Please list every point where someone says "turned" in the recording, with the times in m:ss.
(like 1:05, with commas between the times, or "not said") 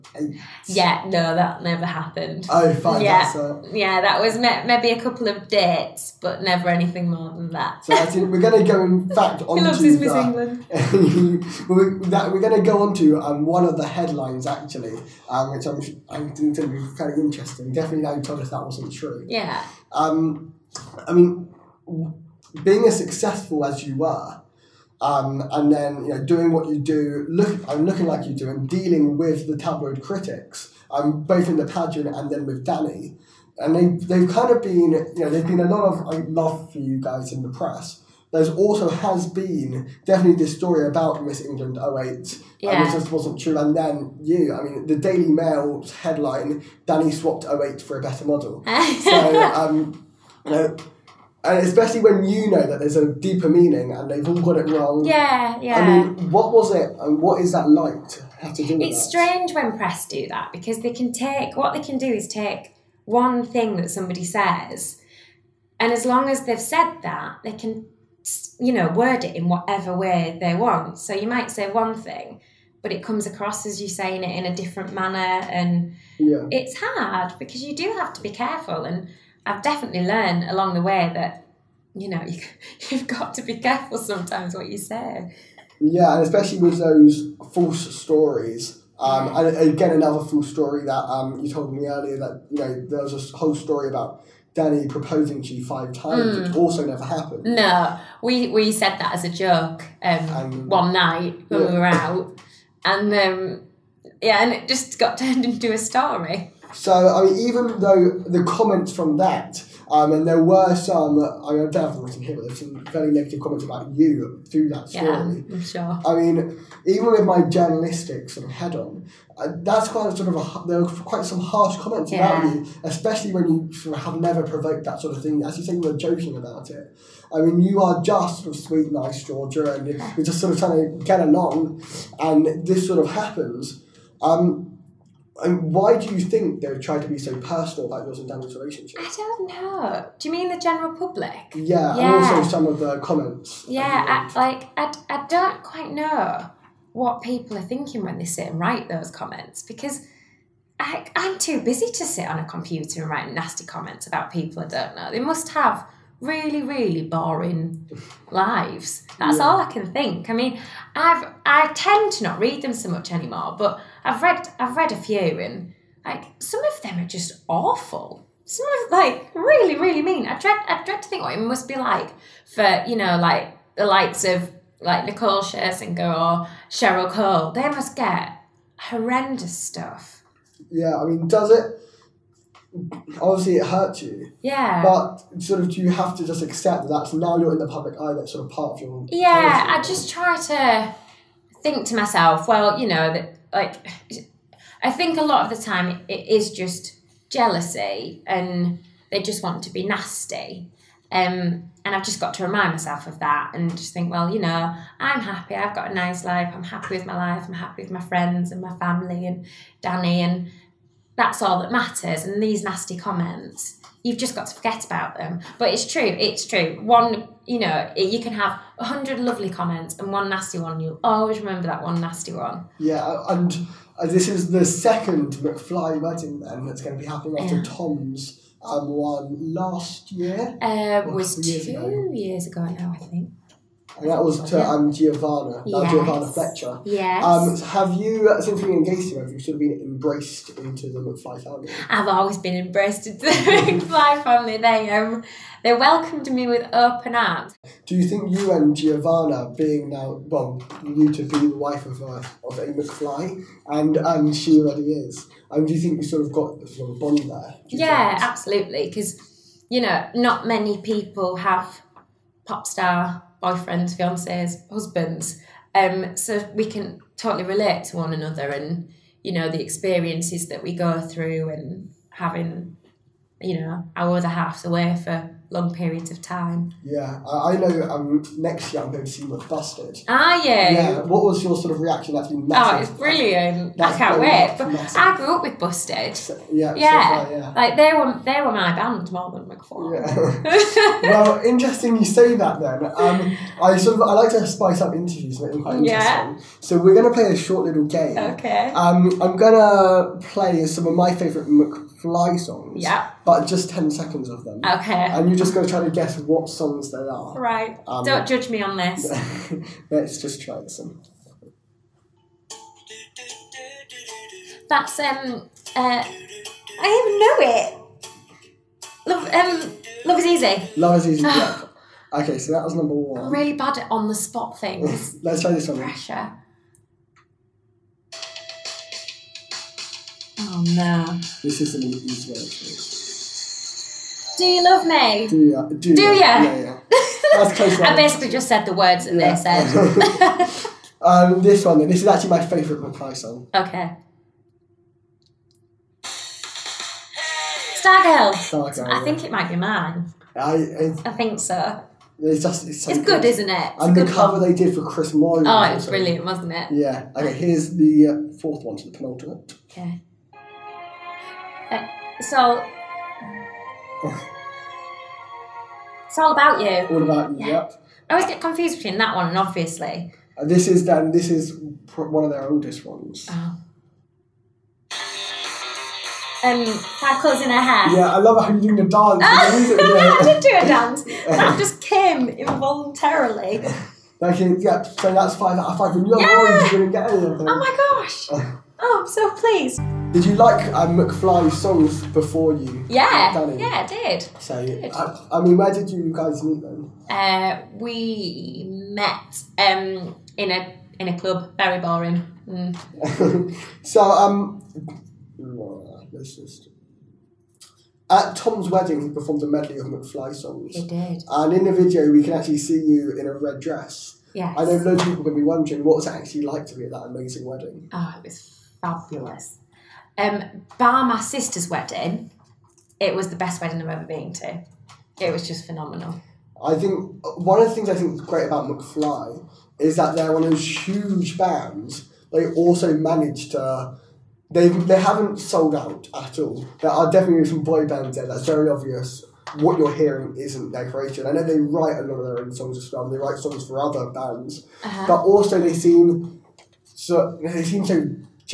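1:45.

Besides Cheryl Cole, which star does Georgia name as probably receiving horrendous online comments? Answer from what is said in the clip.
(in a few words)
Nicole Scherzinger.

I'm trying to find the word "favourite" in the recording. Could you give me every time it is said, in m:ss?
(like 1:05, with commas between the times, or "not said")
5:01, 5:42.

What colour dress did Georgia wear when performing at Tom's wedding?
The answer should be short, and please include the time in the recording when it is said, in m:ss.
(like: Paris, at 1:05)
Red, at 6:53.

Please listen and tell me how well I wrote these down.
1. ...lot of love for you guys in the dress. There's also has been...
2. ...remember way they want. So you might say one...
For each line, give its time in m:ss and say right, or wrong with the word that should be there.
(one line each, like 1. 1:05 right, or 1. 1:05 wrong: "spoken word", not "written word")
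1. 0:35 wrong: "press", not "dress"
2. 1:09 wrong: "whatever", not "remember".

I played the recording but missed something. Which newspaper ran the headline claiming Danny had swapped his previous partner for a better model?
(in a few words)
Daily Mail.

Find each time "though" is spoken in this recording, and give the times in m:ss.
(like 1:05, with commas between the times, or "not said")
1:47.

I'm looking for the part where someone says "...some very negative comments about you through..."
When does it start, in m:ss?
1:52.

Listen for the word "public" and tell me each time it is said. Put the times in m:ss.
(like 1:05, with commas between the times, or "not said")
2:20, 3:07.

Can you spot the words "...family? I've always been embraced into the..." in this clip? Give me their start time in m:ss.
4:01.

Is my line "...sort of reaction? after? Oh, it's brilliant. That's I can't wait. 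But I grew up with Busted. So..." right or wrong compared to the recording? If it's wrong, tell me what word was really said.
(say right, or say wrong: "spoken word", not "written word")
right.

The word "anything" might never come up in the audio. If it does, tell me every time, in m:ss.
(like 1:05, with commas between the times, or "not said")
0:06, 6:27.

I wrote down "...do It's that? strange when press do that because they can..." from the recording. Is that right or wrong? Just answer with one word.
right.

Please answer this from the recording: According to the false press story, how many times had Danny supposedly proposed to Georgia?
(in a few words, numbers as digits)
5.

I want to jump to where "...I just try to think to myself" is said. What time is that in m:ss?
3:09.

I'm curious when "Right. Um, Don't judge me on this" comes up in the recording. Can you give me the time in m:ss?
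5:07.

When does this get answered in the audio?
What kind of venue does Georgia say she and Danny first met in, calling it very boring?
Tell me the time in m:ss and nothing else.
6:41.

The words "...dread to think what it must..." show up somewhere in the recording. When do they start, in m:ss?
2:50.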